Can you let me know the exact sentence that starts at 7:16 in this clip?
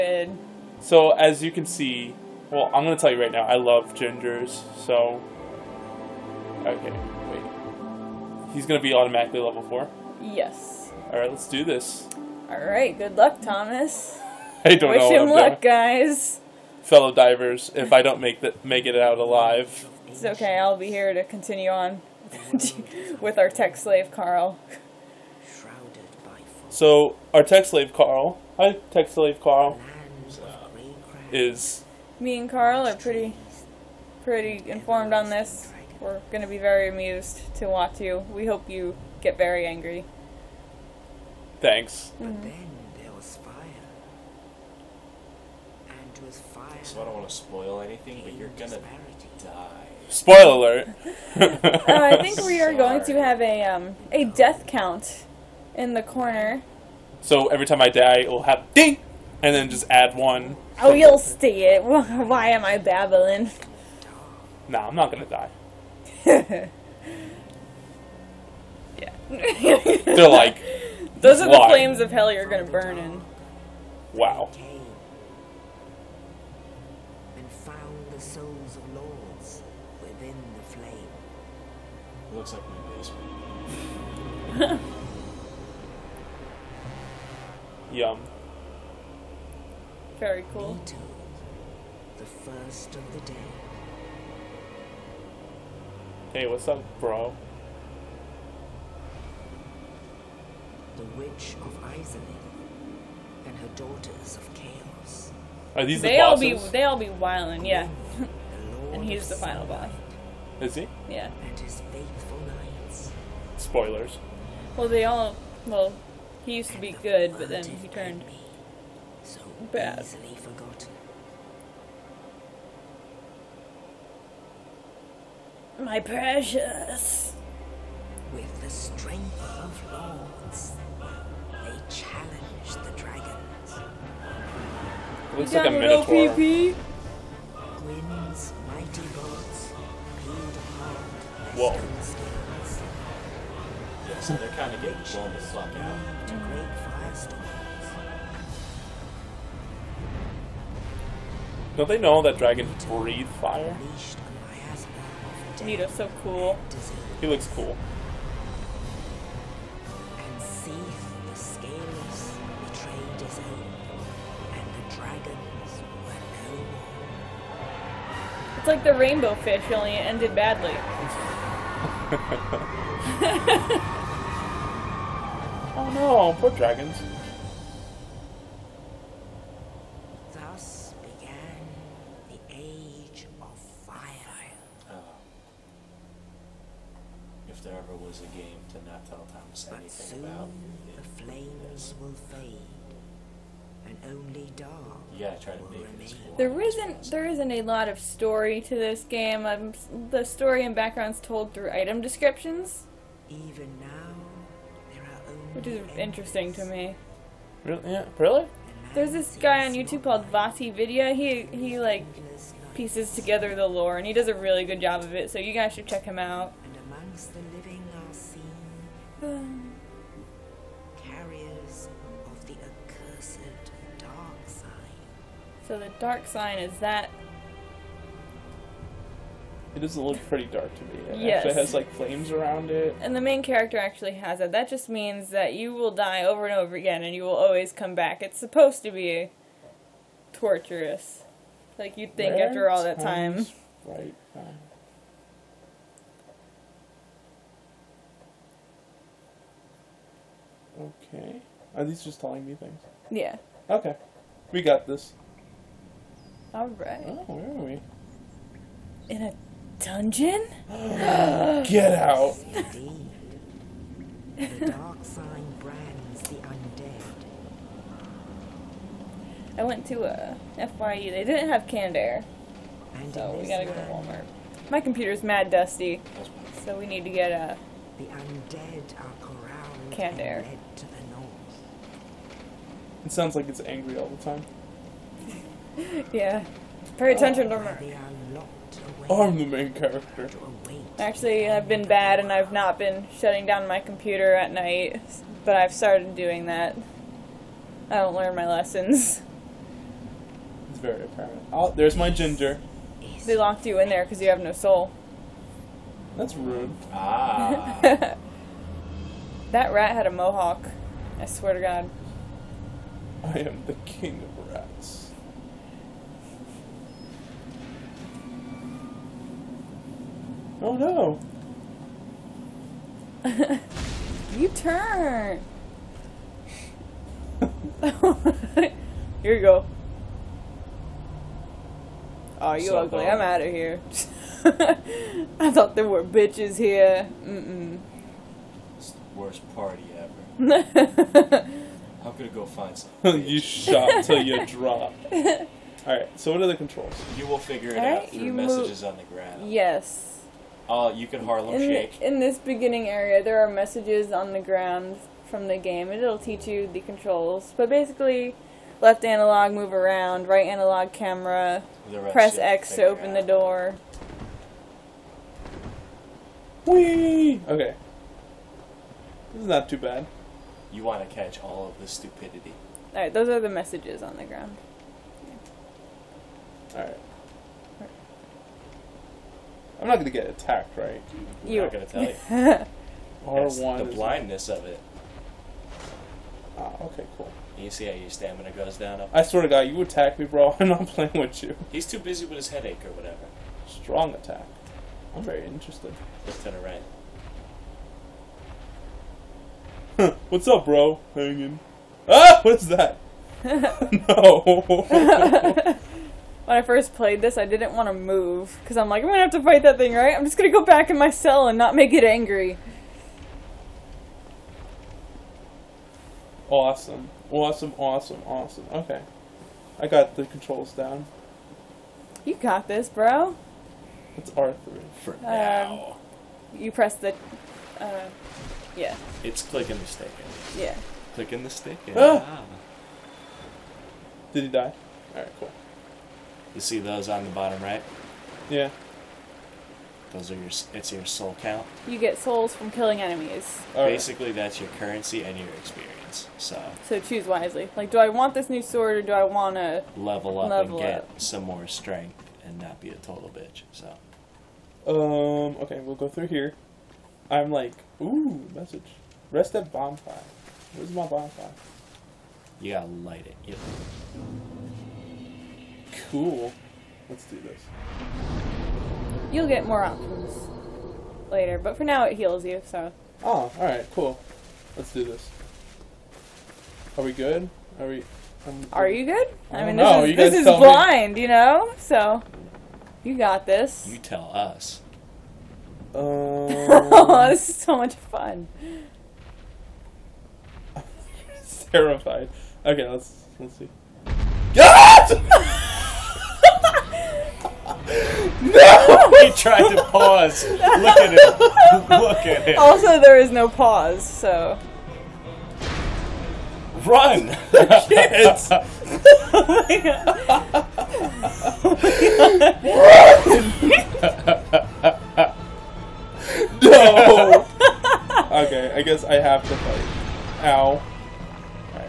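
You see those on the bottom right?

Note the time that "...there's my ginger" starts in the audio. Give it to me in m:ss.
5:01.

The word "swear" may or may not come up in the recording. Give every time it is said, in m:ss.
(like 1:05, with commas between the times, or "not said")
5:11, 6:29.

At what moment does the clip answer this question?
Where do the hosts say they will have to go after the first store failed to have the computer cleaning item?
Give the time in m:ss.
4:33.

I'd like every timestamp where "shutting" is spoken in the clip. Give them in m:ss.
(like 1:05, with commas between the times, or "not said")
4:53.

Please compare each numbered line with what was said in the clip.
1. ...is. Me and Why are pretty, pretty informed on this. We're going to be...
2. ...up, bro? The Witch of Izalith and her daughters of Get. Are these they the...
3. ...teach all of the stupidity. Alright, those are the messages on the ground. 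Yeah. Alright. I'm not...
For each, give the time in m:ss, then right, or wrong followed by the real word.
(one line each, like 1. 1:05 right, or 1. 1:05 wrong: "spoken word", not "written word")
1. 0:31 wrong: "Carl", not "Why"
2. 1:36 wrong: "Chaos", not "Get"
3. 6:11 wrong: "catch", not "teach".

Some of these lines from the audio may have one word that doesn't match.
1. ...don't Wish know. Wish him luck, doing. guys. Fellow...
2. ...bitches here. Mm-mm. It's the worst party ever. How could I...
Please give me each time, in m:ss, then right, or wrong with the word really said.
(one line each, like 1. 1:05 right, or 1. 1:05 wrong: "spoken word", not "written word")
1. 0:14 right
2. 5:36 right.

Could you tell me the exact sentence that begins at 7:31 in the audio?
some more strength and not be a total bitch?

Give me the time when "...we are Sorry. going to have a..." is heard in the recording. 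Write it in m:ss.
0:52.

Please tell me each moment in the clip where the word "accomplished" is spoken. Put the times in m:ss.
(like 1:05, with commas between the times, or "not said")
not said.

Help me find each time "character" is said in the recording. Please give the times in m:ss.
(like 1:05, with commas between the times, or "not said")
3:53, 4:49.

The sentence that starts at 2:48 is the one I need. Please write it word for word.
It's like the rainbow fish, only it ended badly.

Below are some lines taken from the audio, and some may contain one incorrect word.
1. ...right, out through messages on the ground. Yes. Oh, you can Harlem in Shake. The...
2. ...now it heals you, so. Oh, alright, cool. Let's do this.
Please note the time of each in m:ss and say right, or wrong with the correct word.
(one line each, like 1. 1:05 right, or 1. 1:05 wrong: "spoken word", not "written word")
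1. 5:47 right
2. 7:51 right.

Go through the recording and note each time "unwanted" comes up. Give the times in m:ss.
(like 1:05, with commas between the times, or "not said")
not said.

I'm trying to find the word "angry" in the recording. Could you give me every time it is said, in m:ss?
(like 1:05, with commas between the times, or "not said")
0:39, 4:43, 6:52.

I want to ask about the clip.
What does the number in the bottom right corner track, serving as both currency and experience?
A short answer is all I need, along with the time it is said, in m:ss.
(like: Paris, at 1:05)
Soul count, at 7:21.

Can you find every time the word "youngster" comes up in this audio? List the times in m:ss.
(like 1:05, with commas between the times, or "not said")
not said.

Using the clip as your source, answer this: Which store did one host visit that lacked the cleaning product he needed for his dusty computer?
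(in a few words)
FYE.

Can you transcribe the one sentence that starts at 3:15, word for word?
yeah, gotta try to make it There isn't there isn't a lot of story to this game.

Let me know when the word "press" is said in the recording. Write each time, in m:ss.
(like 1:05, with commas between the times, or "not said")
6:02, 7:06.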